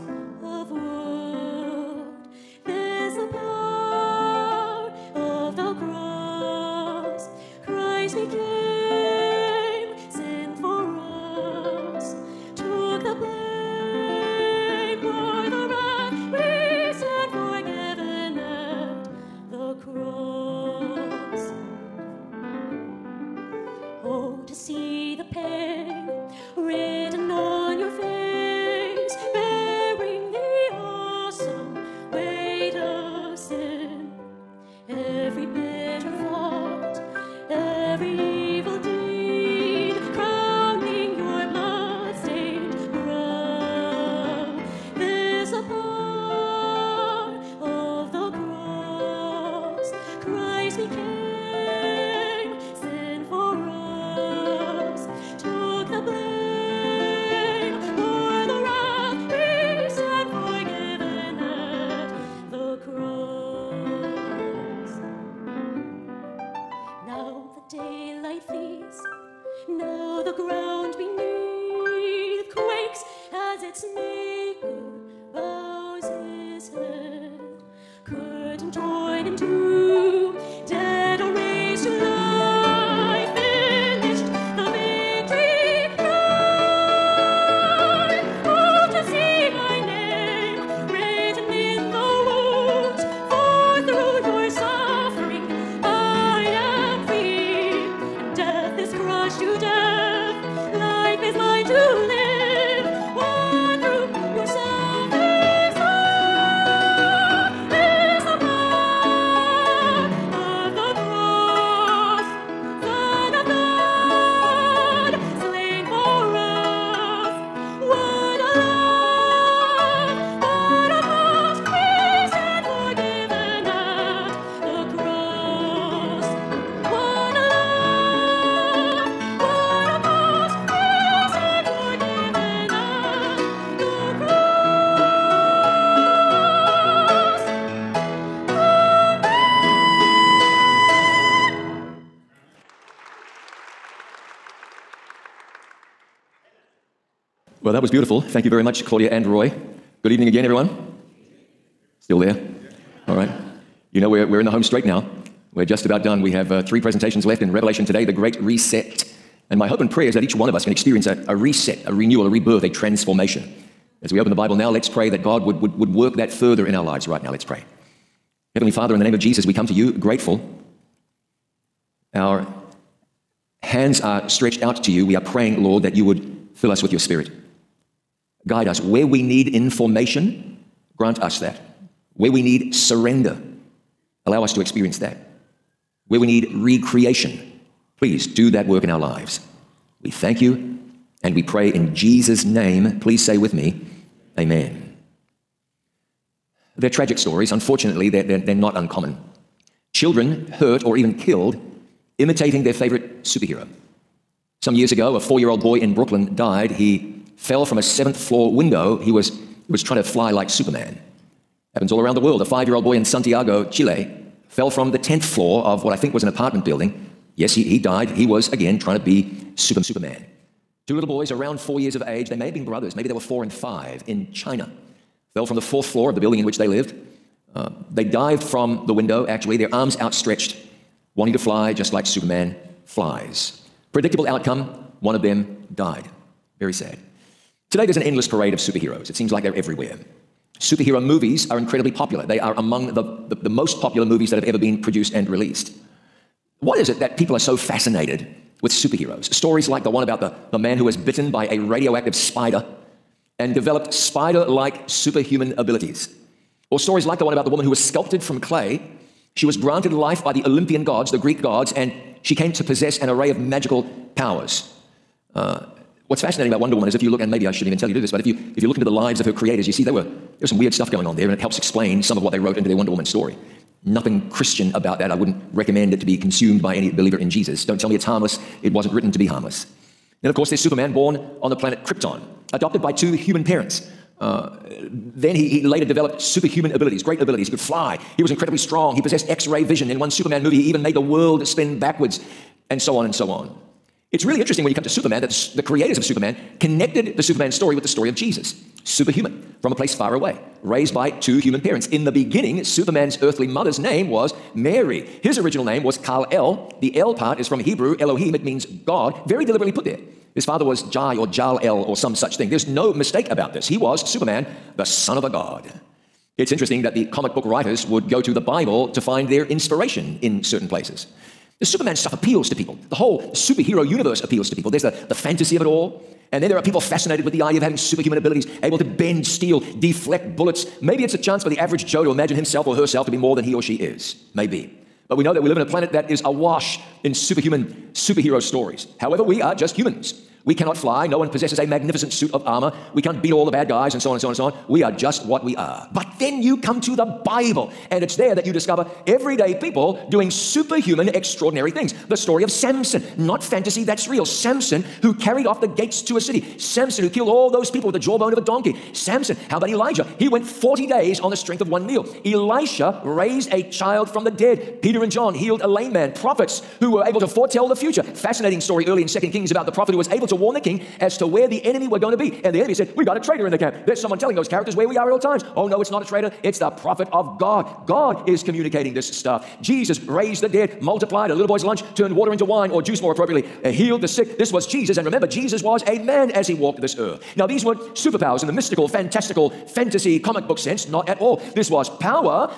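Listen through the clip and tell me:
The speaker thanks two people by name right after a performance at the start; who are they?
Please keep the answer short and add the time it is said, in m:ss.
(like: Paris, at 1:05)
Claudia and Roy, at 2:28.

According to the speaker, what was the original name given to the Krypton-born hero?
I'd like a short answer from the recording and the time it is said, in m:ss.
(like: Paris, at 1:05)
Kal El, at 5:06.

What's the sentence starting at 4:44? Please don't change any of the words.
Uh, then he, he later developed superhuman abilities, great abilities.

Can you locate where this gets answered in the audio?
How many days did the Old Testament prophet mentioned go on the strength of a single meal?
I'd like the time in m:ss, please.
6:00.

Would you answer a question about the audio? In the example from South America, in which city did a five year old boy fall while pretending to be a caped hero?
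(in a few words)
Santiago, Chile.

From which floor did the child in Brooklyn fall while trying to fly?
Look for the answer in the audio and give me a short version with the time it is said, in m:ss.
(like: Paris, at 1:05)
7th floor, at 3:27.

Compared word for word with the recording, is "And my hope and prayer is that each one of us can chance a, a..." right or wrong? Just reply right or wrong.
wrong.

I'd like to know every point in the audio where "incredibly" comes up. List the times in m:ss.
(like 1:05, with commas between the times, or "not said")
4:01, 4:48.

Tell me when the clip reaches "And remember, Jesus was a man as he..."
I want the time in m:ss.
6:24.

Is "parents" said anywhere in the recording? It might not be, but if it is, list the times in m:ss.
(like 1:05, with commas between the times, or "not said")
4:43, 5:01.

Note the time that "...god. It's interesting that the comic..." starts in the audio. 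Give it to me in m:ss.
5:15.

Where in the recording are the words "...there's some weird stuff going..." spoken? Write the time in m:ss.
4:30.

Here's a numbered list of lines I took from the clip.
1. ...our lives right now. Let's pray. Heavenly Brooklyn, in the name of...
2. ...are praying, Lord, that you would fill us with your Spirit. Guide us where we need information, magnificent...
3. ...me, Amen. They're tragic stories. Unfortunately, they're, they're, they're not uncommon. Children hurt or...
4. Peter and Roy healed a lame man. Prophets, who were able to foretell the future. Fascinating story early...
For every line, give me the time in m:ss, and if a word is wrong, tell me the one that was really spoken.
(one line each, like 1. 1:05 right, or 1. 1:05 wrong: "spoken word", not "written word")
1. 2:46 wrong: "Father", not "Brooklyn"
2. 2:55 wrong: "grant", not "magnificent"
3. 3:13 right
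4. 6:04 wrong: "John", not "Roy".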